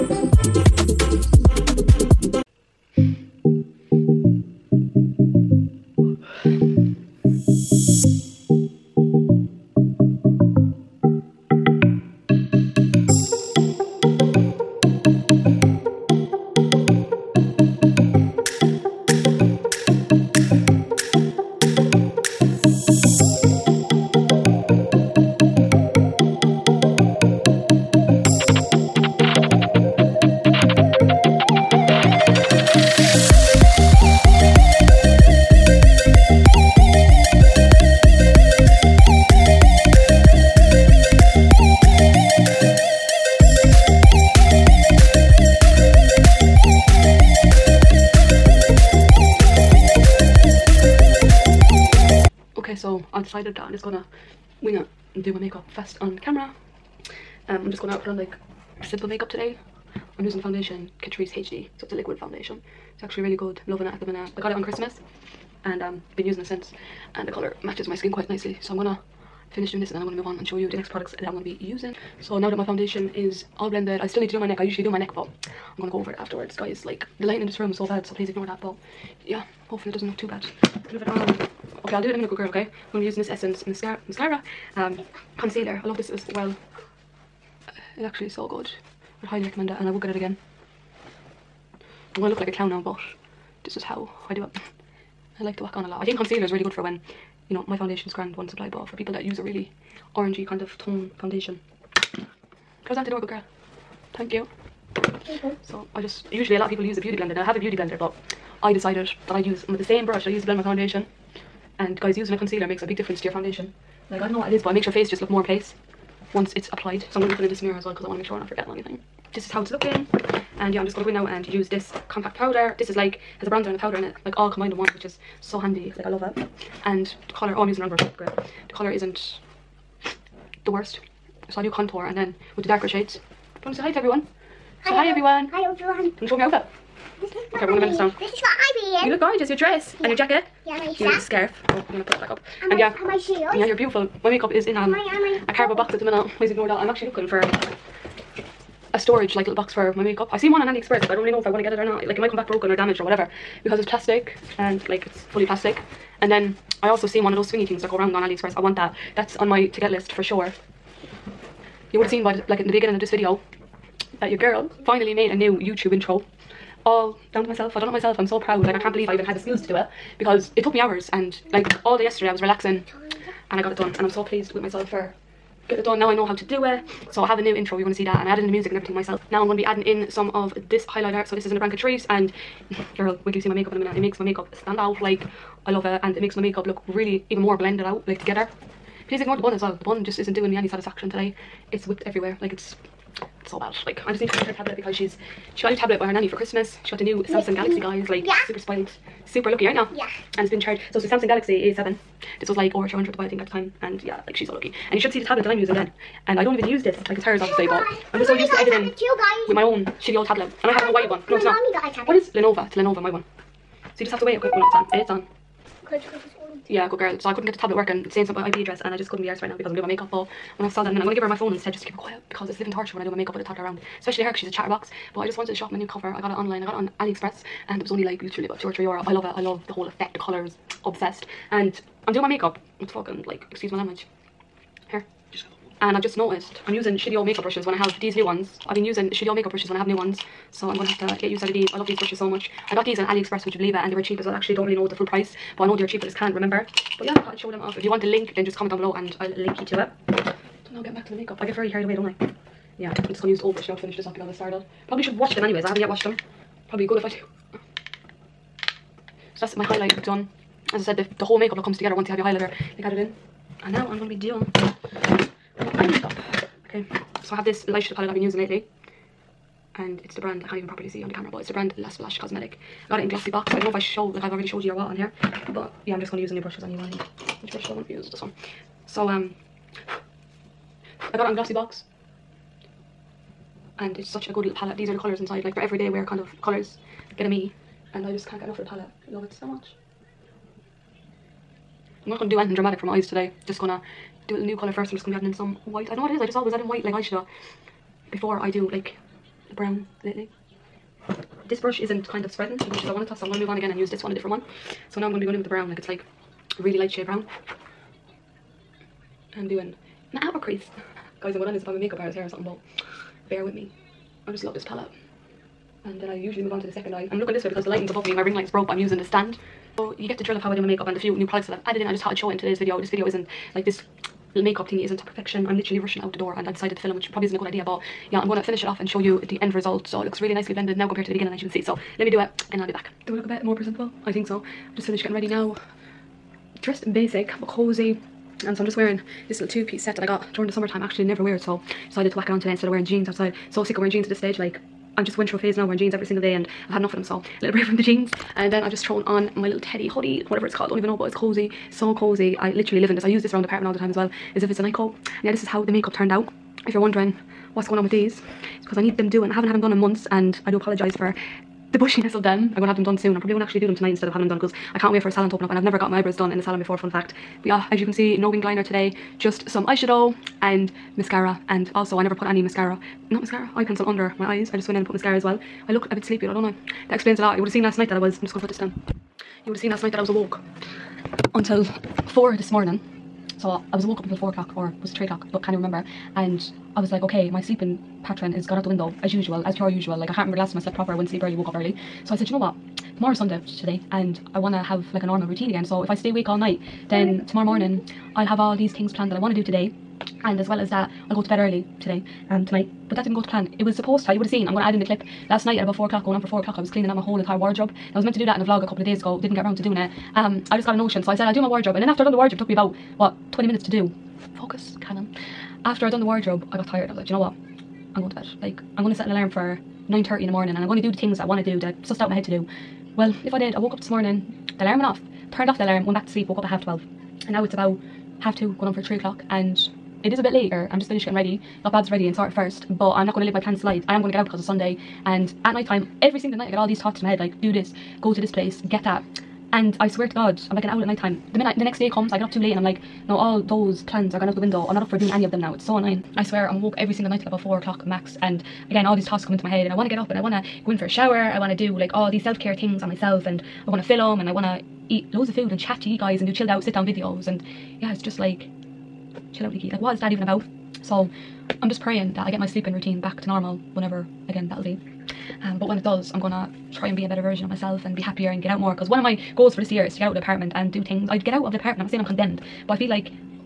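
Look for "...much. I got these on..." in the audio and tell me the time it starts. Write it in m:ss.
4:02.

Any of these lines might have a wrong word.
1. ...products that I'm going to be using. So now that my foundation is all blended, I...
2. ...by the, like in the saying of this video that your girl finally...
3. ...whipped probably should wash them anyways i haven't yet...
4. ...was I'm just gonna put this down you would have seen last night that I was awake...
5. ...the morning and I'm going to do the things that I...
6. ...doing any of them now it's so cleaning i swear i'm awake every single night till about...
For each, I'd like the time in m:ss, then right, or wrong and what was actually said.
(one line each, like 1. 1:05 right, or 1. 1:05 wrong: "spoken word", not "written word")
1. 1:10 right
2. 2:42 wrong: "beginning", not "saying"
3. 4:14 wrong: "started", not "whipped"
4. 6:17 right
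5. 7:00 right
6. 7:24 wrong: "annoying", not "cleaning".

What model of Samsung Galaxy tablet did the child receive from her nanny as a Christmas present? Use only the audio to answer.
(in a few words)
A7.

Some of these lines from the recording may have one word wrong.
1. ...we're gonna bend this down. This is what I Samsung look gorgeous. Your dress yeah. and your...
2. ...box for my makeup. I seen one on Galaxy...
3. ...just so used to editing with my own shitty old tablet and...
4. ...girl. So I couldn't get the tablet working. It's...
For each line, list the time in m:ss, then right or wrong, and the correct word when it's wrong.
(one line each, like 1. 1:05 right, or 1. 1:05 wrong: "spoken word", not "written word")
1. 2:17 wrong: "You", not "Samsung"
2. 2:29 wrong: "AliExpress", not "Galaxy"
3. 3:28 right
4. 3:36 right.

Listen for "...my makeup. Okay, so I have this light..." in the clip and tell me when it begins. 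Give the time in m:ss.
4:25.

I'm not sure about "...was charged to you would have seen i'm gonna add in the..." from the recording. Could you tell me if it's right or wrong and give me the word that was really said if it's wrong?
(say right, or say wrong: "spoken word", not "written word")
wrong: "supposed", not "charged".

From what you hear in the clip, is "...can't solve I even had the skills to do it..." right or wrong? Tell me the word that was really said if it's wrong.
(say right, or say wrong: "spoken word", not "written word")
wrong: "believe", not "solve".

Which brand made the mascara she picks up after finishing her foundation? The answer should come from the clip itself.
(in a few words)
Essence.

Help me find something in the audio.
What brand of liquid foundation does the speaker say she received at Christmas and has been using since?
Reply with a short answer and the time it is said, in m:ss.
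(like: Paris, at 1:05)
Catrice HD, at 1:01.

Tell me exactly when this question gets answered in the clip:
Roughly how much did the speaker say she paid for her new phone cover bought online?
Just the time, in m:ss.
3:48.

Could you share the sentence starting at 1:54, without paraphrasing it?
Like, I don't know what it is, but it makes your face just look more in place once it's applied.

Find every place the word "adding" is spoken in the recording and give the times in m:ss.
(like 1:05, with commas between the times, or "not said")
2:59, 4:55.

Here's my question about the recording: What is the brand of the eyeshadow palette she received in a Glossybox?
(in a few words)
La Splash Cosmetic.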